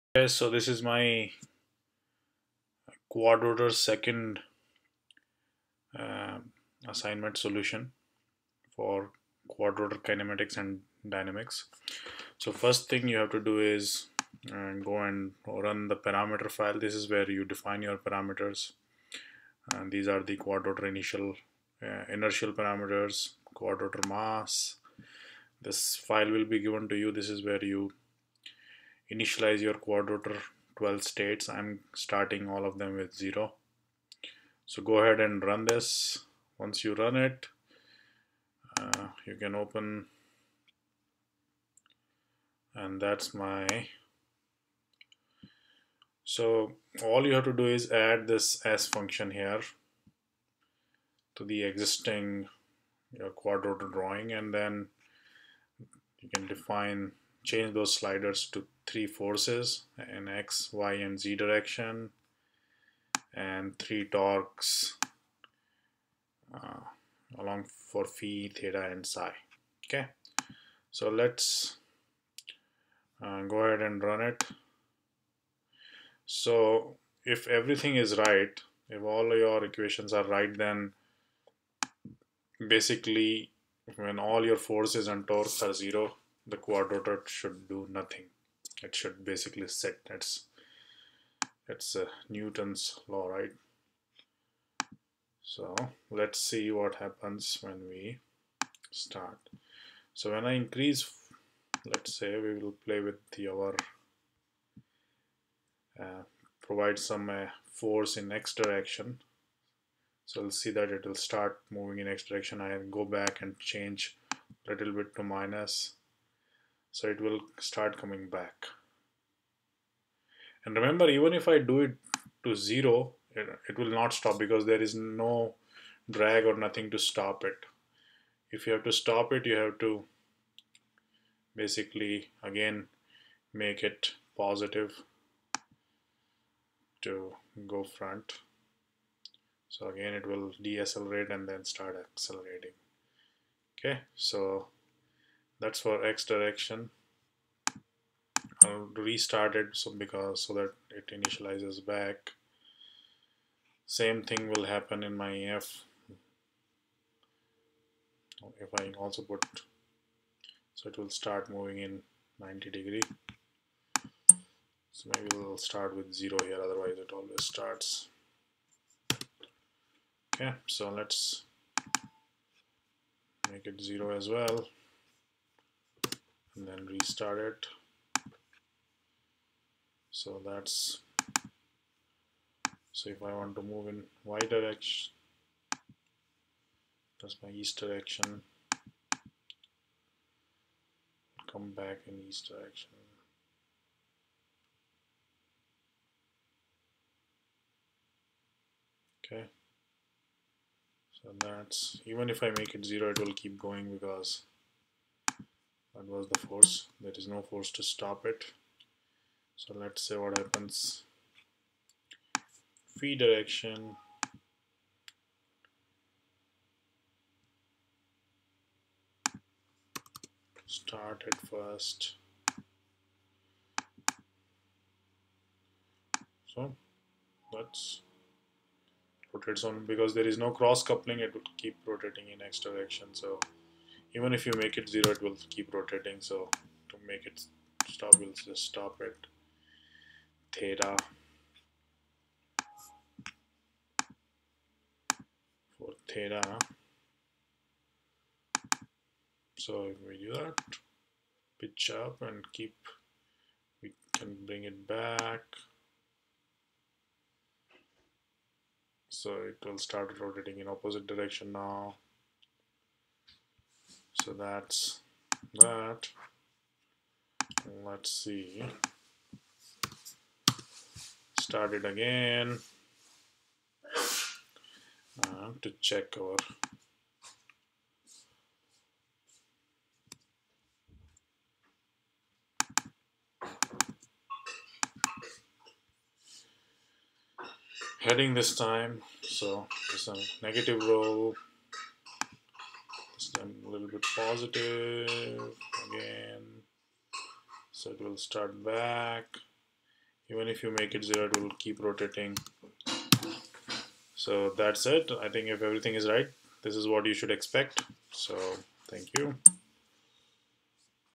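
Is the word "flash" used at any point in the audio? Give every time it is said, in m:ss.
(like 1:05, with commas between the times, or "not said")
not said.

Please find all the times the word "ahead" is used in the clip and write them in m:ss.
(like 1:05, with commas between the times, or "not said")
0:34, 1:13.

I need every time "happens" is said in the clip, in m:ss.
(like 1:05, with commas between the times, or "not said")
1:36, 2:34, 3:30.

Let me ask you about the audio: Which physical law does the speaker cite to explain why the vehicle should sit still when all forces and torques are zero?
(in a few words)
Newton's law.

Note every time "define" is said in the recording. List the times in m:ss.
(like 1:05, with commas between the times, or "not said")
0:17, 0:56.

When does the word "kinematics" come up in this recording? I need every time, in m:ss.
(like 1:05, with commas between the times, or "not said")
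0:10.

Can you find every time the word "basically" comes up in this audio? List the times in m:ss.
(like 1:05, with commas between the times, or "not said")
1:22, 1:29, 2:11.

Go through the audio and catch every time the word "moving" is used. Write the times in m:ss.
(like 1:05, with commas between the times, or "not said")
1:51, 2:41.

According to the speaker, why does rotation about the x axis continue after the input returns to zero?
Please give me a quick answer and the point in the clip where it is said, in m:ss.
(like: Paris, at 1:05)
No cross coupling, at 3:50.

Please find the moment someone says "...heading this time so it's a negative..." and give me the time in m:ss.
4:48.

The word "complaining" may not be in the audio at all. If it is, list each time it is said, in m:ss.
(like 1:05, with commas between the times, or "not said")
not said.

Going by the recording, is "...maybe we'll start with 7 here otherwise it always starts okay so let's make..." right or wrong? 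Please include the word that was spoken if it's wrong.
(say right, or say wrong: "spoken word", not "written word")
wrong: "0", not "7".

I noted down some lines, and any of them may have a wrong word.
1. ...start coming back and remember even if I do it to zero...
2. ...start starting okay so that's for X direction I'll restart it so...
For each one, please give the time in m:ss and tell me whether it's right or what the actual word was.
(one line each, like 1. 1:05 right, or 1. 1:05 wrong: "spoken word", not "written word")
1. 1:57 right
2. 2:21 wrong: "accelerating", not "starting".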